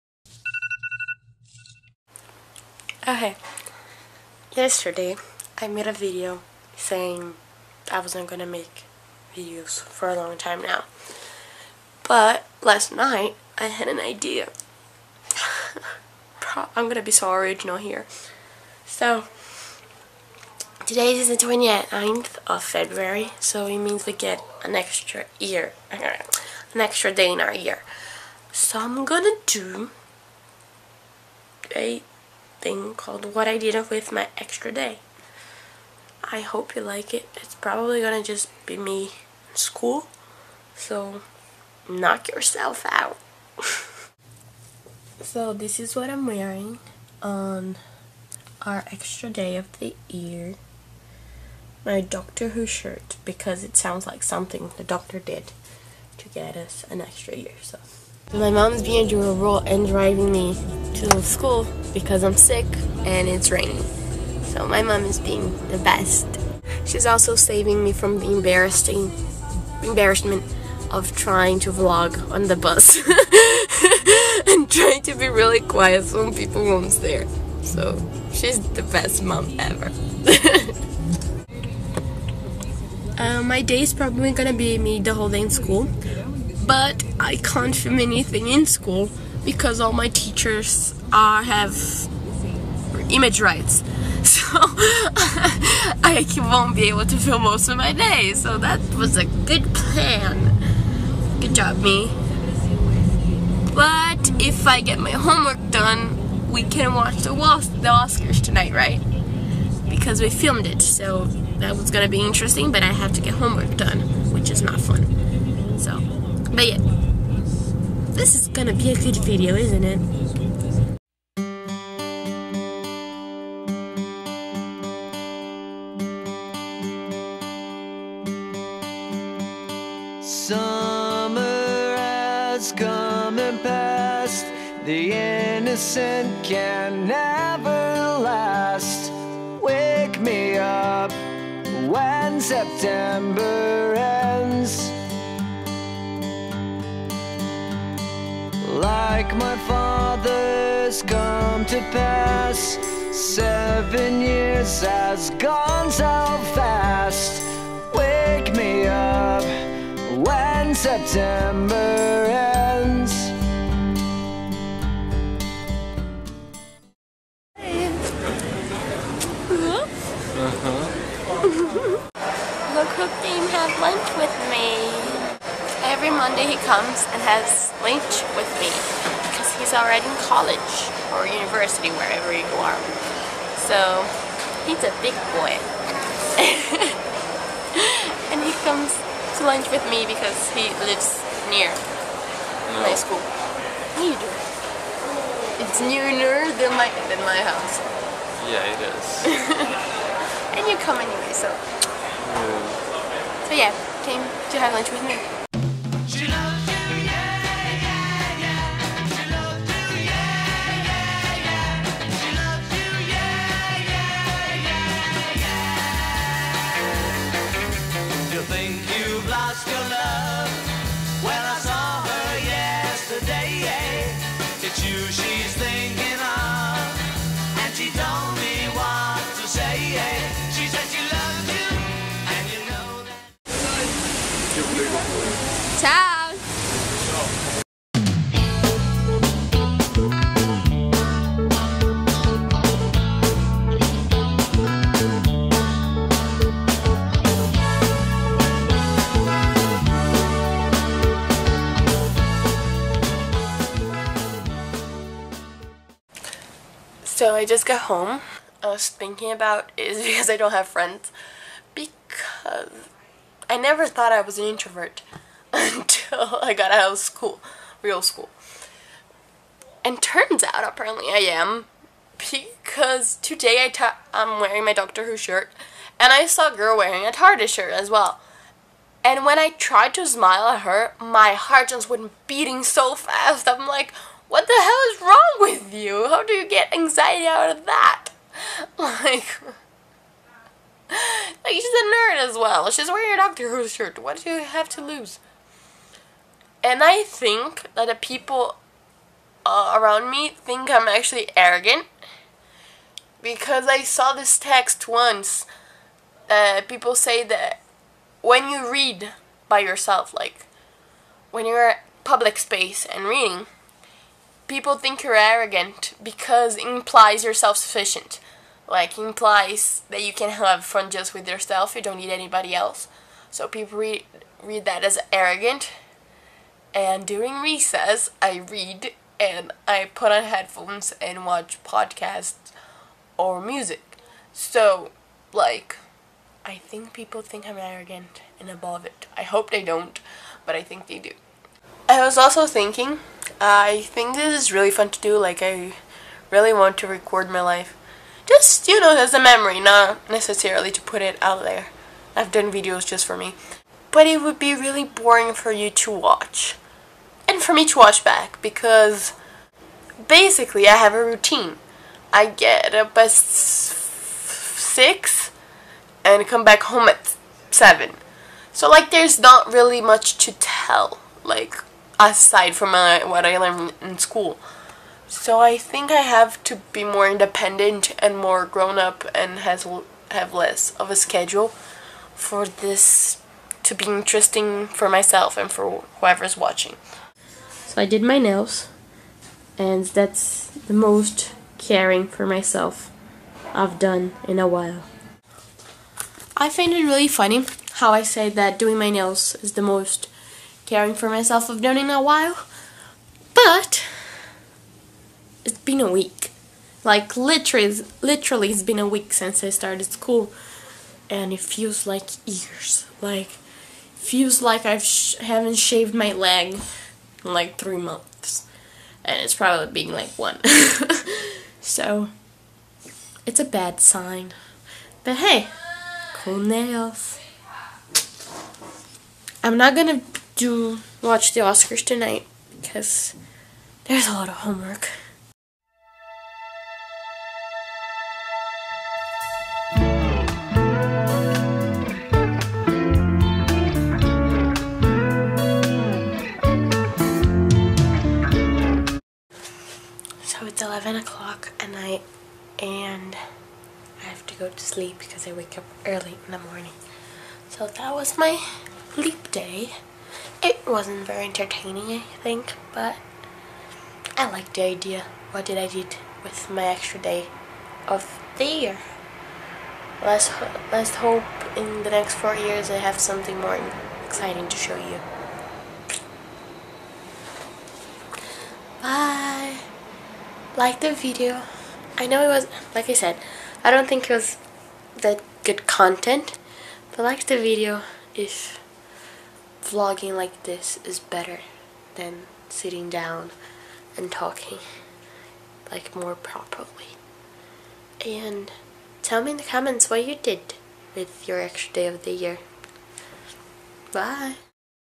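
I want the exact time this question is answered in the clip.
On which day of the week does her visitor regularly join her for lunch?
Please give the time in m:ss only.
2:55.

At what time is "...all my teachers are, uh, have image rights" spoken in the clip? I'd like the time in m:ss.
1:29.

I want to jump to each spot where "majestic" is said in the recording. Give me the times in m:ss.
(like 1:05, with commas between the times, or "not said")
not said.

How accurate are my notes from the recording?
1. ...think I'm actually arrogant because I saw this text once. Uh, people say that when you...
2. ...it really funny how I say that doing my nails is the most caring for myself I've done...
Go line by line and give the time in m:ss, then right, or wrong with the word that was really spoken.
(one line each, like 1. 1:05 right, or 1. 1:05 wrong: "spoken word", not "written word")
1. 5:00 right
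2. 6:36 right.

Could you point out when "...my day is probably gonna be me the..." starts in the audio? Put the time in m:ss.
1:23.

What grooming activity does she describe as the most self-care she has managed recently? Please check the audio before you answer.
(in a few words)
Did my nails.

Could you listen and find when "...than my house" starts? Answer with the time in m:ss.
3:17.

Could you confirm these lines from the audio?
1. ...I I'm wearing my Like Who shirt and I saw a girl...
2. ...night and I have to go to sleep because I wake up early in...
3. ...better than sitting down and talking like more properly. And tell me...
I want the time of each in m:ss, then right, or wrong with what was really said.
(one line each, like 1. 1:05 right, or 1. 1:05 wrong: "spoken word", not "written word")
1. 4:33 wrong: "Doctor", not "Like"
2. 7:31 right
3. 8:10 right.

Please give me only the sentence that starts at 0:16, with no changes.
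I'm gonna be so original here.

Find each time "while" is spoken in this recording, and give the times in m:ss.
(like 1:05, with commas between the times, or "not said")
6:34, 6:42.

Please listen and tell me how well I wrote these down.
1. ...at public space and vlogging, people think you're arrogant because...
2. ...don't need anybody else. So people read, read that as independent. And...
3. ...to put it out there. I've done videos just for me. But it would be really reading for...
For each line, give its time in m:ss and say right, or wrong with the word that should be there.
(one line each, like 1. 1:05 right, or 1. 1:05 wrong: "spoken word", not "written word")
1. 5:11 wrong: "reading", not "vlogging"
2. 5:21 wrong: "arrogant", not "independent"
3. 5:50 wrong: "boring", not "reading".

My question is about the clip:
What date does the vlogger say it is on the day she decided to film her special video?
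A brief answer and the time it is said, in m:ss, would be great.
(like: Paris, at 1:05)
29th of February, at 0:21.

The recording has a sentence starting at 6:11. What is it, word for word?
Like, aside from my, uh, what I learned in school.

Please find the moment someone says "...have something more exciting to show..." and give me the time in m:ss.
7:52.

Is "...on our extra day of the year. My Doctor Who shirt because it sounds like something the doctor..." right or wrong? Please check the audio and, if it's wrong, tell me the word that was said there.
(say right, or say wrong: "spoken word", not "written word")
right.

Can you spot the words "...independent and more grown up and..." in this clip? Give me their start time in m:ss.
6:17.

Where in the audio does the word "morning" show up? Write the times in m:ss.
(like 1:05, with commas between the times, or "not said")
7:36.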